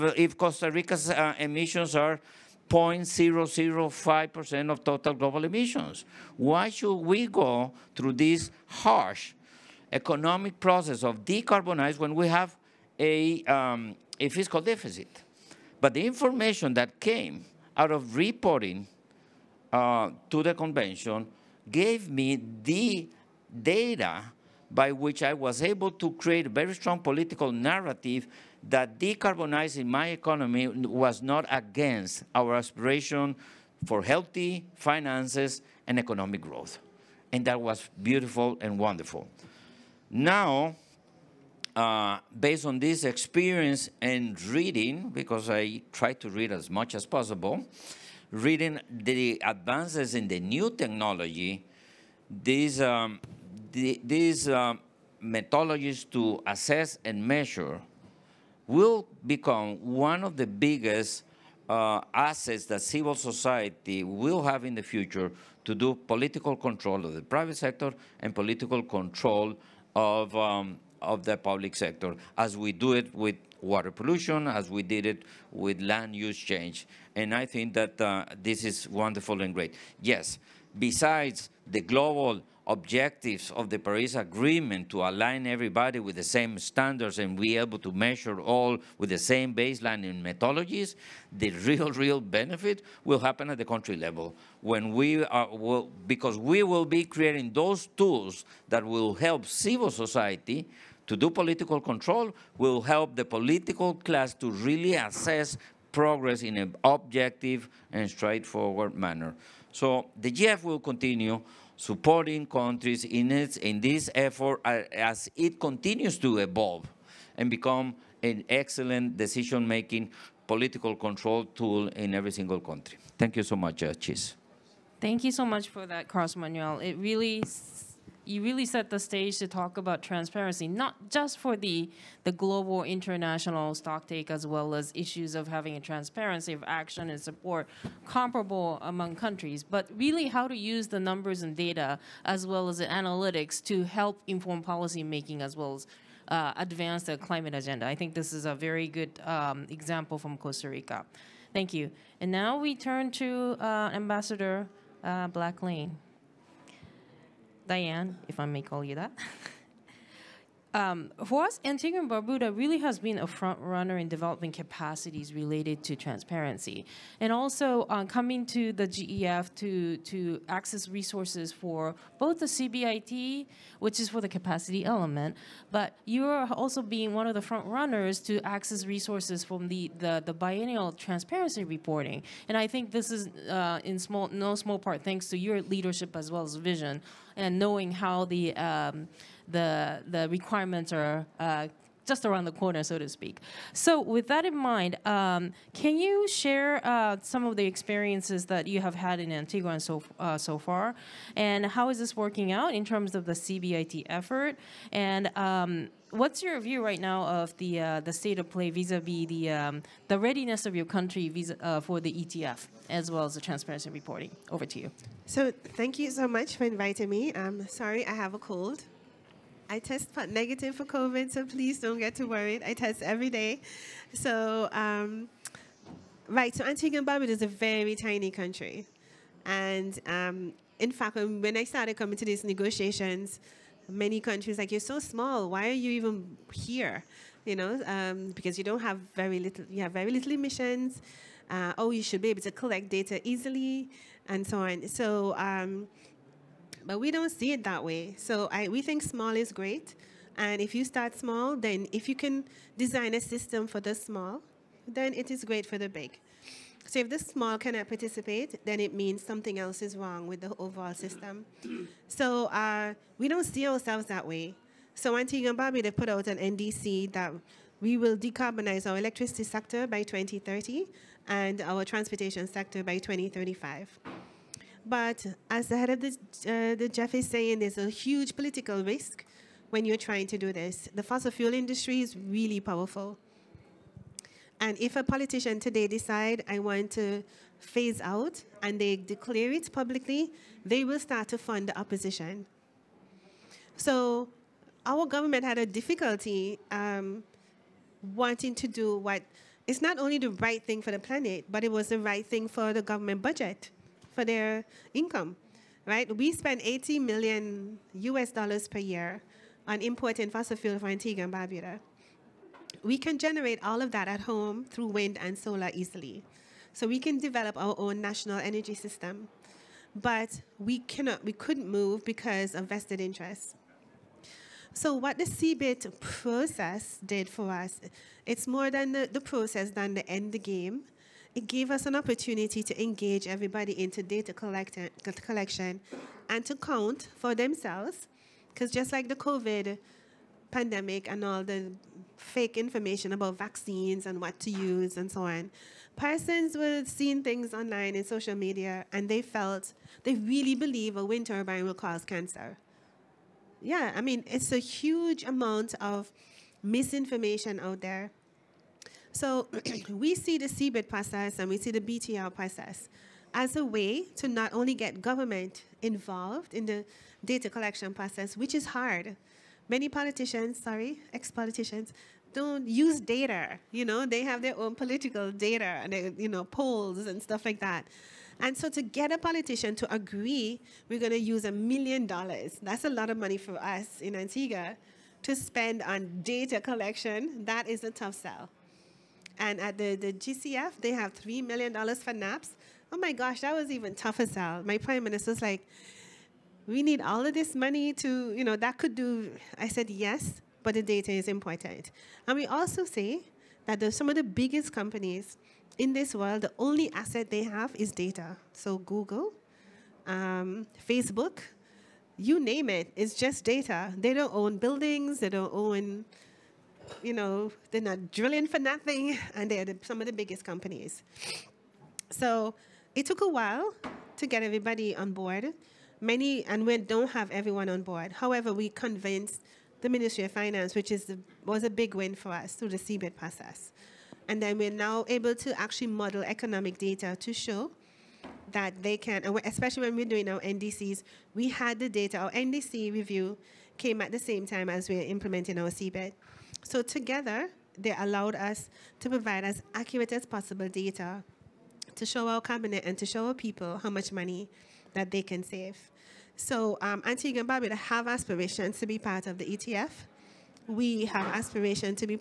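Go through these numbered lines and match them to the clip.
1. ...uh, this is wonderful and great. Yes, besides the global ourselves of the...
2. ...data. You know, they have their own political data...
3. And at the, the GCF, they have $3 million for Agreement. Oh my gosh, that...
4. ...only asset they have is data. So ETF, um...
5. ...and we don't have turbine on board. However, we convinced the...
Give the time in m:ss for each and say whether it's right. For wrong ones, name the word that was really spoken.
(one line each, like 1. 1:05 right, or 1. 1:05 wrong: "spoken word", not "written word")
1. 1:18 wrong: "objectives", not "ourselves"
2. 6:12 right
3. 6:29 wrong: "NAPS", not "Agreement"
4. 6:46 wrong: "Google", not "ETF"
5. 7:06 wrong: "everyone", not "turbine".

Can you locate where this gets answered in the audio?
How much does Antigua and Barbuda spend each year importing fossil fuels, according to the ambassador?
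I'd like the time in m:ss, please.
5:06.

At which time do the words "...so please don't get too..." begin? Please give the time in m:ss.
3:41.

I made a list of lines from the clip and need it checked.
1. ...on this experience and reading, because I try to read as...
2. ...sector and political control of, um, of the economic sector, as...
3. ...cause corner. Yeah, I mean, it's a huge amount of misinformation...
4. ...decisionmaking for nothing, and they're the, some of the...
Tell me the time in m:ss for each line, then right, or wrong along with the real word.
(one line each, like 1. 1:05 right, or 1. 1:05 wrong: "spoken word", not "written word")
1. 0:42 right
2. 1:07 wrong: "public", not "economic"
3. 5:51 wrong: "cancer", not "corner"
4. 6:58 wrong: "drilling", not "decisionmaking".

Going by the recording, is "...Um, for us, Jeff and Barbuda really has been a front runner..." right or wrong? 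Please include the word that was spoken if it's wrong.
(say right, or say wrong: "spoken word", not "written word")
wrong: "Antigua", not "Jeff".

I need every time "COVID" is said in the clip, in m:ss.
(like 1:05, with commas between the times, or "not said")
3:40, 5:39.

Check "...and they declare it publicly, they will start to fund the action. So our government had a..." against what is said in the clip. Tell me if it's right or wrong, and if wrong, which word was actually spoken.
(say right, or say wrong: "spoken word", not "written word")
wrong: "opposition", not "action".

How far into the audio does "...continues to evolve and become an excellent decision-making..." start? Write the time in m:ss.
1:55.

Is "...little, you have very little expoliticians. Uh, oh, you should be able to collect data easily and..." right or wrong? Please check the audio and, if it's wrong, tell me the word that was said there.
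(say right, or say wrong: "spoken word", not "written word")
wrong: "emissions", not "expoliticians".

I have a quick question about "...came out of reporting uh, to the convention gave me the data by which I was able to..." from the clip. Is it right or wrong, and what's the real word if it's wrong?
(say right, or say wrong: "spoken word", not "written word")
right.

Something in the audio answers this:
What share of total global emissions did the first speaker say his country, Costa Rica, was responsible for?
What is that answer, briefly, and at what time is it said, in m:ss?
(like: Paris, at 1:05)
0.005%, at 0:02.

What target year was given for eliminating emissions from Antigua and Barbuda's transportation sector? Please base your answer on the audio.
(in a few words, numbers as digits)
2035.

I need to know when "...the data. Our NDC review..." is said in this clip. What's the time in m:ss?
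7:21.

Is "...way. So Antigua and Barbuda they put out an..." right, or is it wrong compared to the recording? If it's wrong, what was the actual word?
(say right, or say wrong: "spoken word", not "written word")
right.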